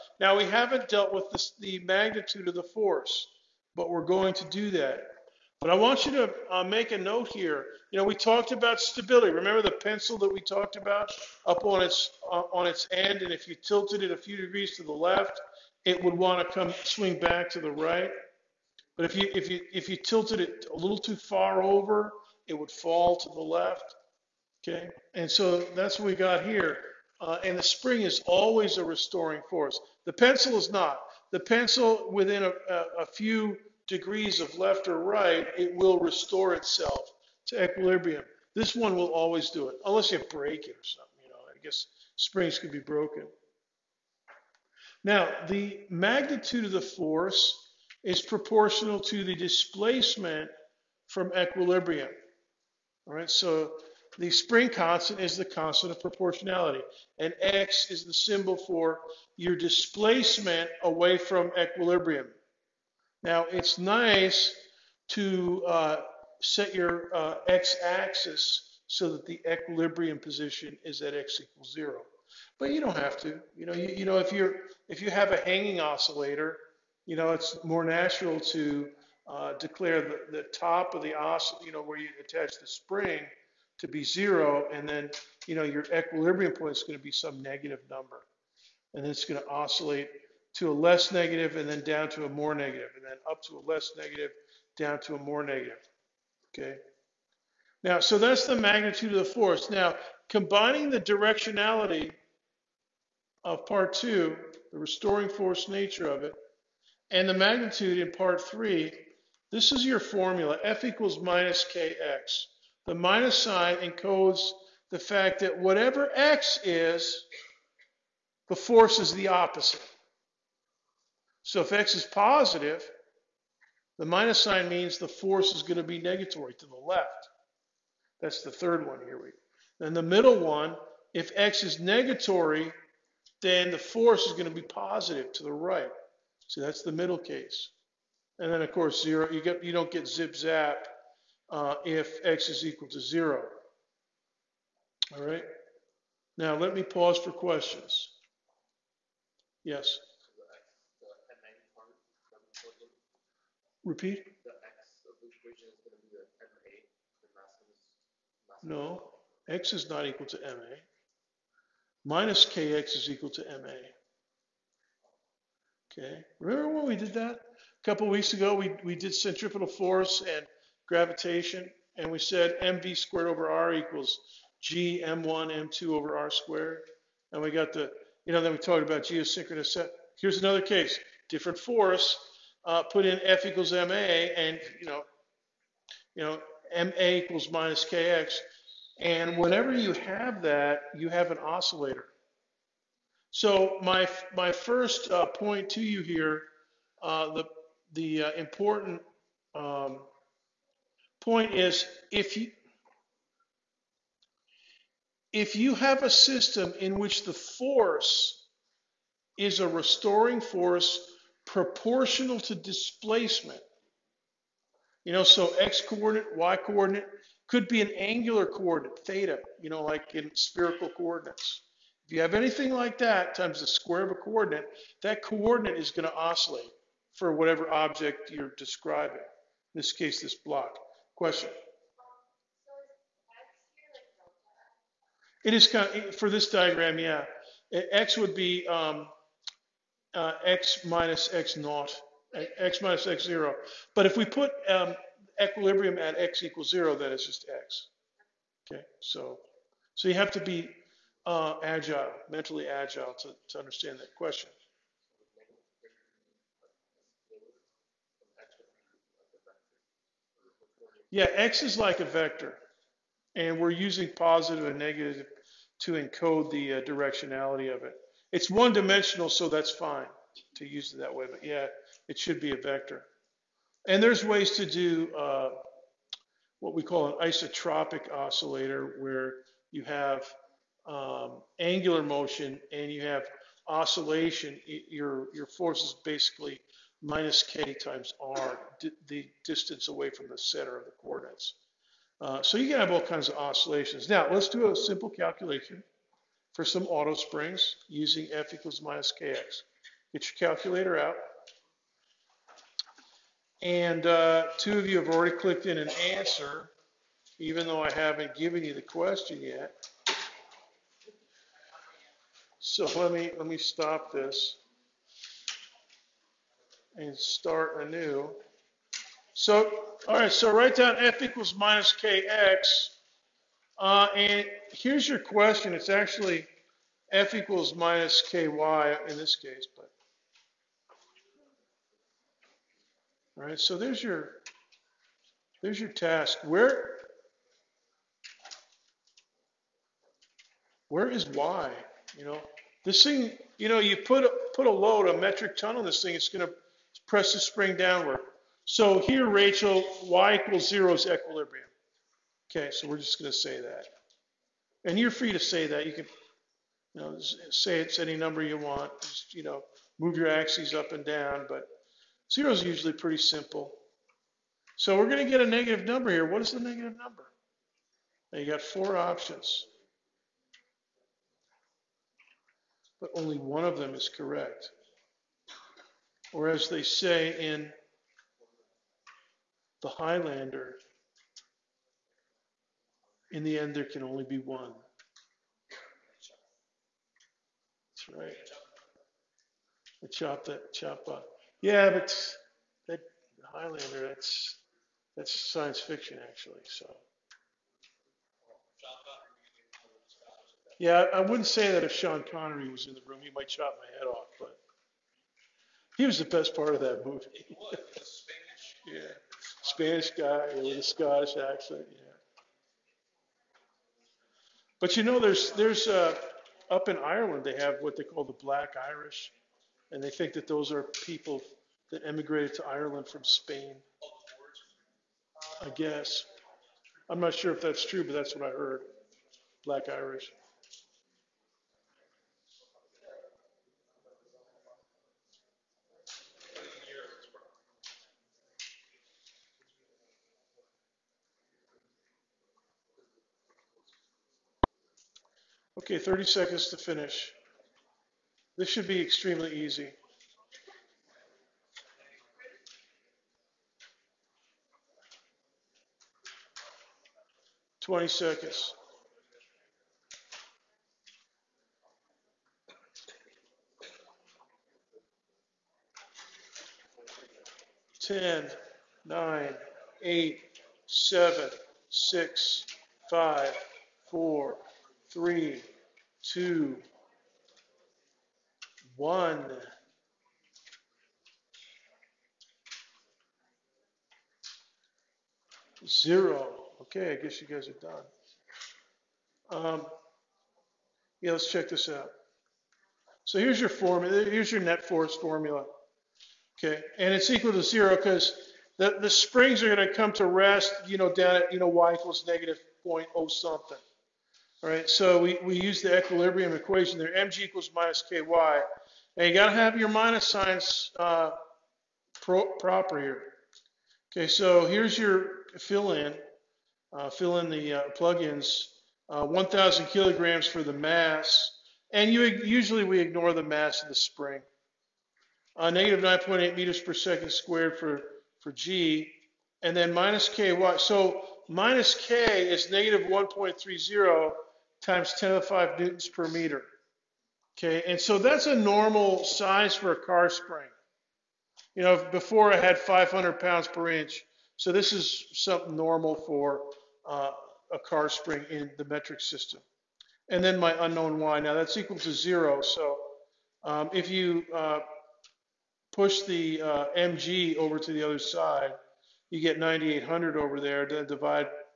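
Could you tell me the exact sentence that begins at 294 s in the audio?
Now, let's do a simple calculation for some auto springs using f equals minus kx.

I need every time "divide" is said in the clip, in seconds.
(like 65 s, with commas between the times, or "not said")
561 s.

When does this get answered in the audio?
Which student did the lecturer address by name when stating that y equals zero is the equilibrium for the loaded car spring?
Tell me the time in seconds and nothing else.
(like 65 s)
349 s.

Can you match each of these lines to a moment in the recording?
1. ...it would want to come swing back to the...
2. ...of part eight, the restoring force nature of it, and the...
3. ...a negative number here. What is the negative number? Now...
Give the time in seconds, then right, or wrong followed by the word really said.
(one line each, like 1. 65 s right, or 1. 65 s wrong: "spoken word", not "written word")
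1. 15 s right
2. 103 s wrong: "two", not "eight"
3. 365 s right.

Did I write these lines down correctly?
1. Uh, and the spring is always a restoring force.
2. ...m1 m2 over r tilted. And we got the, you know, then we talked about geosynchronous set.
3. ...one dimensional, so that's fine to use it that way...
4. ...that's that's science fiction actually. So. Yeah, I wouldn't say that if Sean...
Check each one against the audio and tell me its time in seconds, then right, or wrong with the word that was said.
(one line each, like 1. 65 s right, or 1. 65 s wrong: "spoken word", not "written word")
1. 27 s right
2. 175 s wrong: "squared", not "tilted"
3. 268 s right
4. 394 s right.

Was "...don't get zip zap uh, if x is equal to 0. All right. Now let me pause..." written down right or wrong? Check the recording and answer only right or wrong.
right.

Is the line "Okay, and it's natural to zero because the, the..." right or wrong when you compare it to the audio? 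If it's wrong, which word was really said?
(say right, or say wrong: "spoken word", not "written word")
wrong: "equal", not "natural".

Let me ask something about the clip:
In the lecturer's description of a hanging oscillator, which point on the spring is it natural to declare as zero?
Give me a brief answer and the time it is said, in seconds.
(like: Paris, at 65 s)
the top, at 80 s.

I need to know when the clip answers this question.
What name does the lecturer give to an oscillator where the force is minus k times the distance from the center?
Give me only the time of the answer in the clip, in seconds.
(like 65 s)
277 s.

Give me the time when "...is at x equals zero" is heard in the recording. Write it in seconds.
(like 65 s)
70 s.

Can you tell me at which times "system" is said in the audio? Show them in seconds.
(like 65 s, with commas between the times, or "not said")
206 s, 549 s.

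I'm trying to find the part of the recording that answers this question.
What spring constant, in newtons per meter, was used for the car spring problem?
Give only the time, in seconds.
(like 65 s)
533 s.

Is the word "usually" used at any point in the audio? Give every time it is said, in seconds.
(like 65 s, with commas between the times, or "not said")
362 s, 522 s.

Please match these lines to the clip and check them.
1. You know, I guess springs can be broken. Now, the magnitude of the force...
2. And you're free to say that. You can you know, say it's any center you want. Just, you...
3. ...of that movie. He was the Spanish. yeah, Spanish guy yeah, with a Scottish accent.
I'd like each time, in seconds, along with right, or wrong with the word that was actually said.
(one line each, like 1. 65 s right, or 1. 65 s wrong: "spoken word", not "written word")
1. 41 s right
2. 354 s wrong: "number", not "center"
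3. 406 s right.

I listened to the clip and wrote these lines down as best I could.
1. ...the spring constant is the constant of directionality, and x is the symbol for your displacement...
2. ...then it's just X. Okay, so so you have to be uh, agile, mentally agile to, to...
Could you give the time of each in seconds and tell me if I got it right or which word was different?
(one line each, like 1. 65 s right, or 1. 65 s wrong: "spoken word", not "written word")
1. 54 s wrong: "proportionality", not "directionality"
2. 246 s right.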